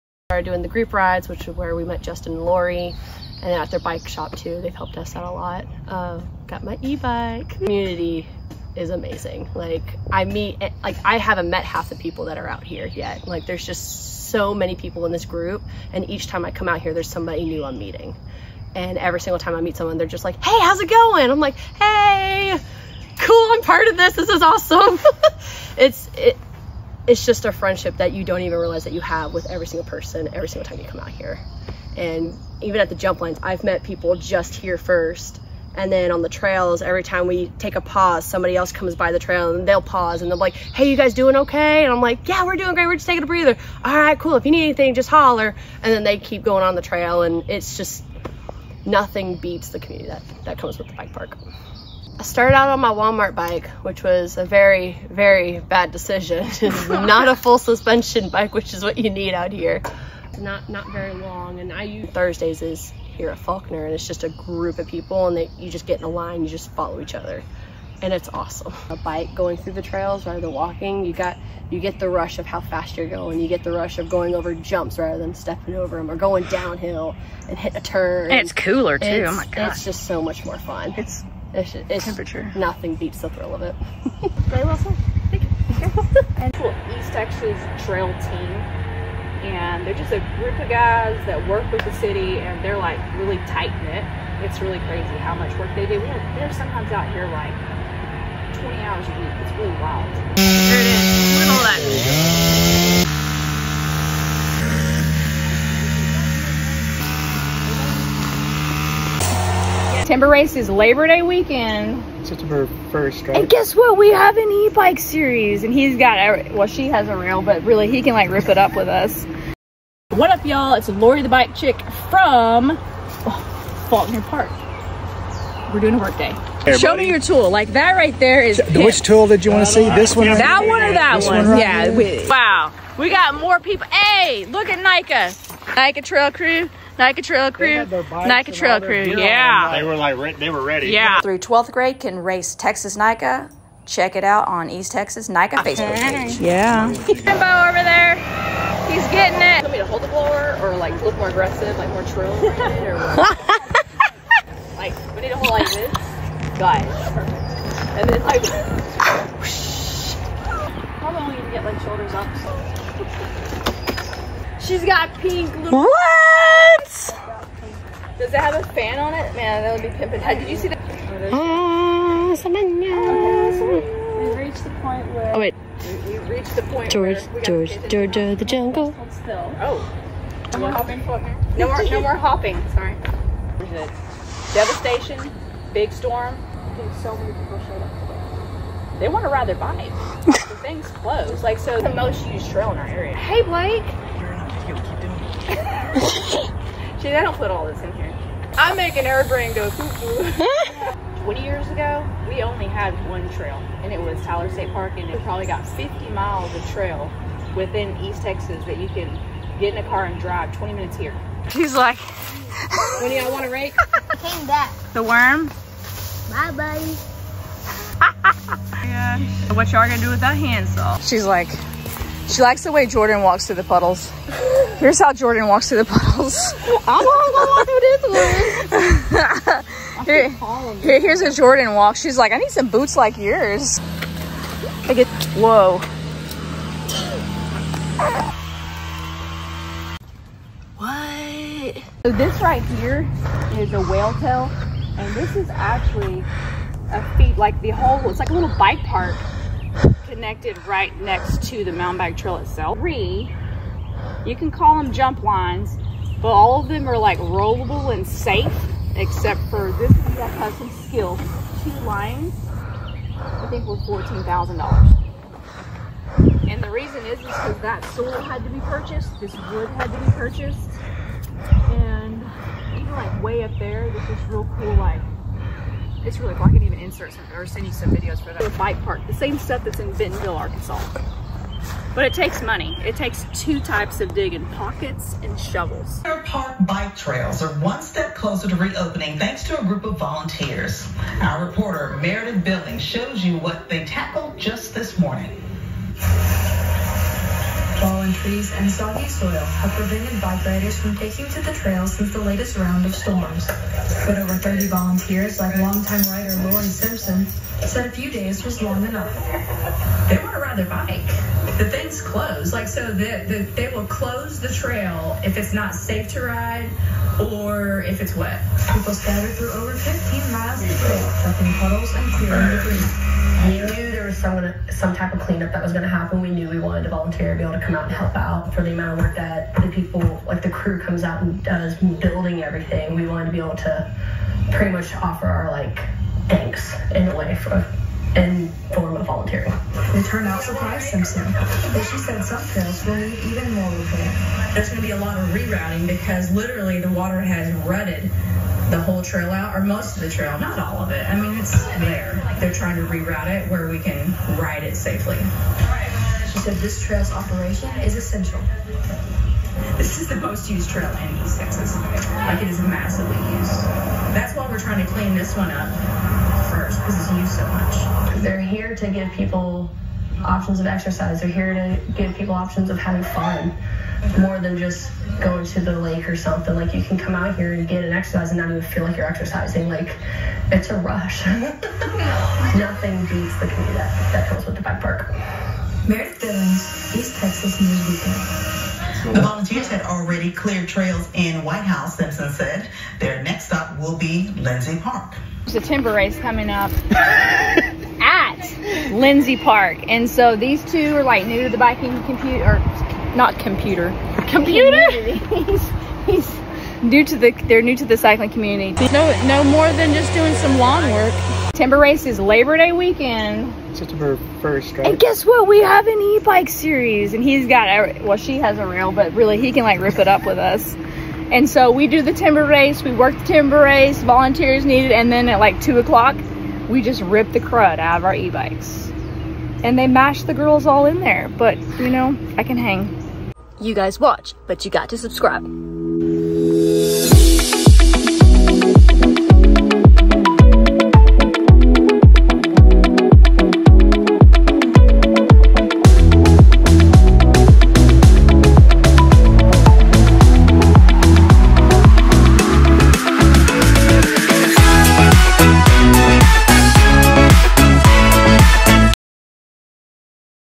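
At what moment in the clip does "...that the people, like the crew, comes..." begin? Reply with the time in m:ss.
5:29.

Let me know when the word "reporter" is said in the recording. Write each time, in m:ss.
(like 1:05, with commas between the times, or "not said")
4:51.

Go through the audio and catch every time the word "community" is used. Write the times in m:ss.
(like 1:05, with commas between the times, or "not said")
0:07, 0:49, 6:23, 6:48.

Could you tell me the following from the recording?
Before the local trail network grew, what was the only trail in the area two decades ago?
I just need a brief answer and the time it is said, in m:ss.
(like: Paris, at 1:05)
Tyler State Park, at 3:24.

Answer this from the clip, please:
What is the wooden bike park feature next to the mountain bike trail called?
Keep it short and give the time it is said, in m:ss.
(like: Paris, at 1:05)
whale tail, at 4:03.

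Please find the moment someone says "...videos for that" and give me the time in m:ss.
4:37.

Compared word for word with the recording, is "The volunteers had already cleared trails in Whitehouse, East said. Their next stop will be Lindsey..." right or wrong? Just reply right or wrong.
wrong.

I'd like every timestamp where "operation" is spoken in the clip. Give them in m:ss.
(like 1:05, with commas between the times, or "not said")
5:57.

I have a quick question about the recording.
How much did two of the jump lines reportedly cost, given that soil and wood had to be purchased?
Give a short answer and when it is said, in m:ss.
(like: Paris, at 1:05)
$14,000, at 4:23.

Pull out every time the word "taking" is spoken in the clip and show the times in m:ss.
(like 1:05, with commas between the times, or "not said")
0:43, 5:00.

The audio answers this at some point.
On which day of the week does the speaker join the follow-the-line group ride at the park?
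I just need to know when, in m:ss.
1:02.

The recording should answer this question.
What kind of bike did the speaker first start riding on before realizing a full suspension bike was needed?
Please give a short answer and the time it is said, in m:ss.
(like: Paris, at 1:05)
Walmart bike, at 0:52.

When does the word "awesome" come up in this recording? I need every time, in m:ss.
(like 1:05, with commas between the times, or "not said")
0:24, 1:08.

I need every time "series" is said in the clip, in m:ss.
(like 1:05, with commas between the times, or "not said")
1:54, 6:56.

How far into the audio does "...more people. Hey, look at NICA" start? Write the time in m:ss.
2:13.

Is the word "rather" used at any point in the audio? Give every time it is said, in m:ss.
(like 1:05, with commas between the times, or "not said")
1:10, 1:14.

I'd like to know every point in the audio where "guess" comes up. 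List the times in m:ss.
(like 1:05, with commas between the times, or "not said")
1:53, 6:54.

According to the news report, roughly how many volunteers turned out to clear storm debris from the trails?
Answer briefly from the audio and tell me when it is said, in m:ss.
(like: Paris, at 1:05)
over 30, at 5:04.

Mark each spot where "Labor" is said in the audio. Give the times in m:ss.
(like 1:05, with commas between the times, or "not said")
1:50, 6:52.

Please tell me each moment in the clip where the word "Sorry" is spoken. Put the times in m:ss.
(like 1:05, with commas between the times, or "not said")
3:02.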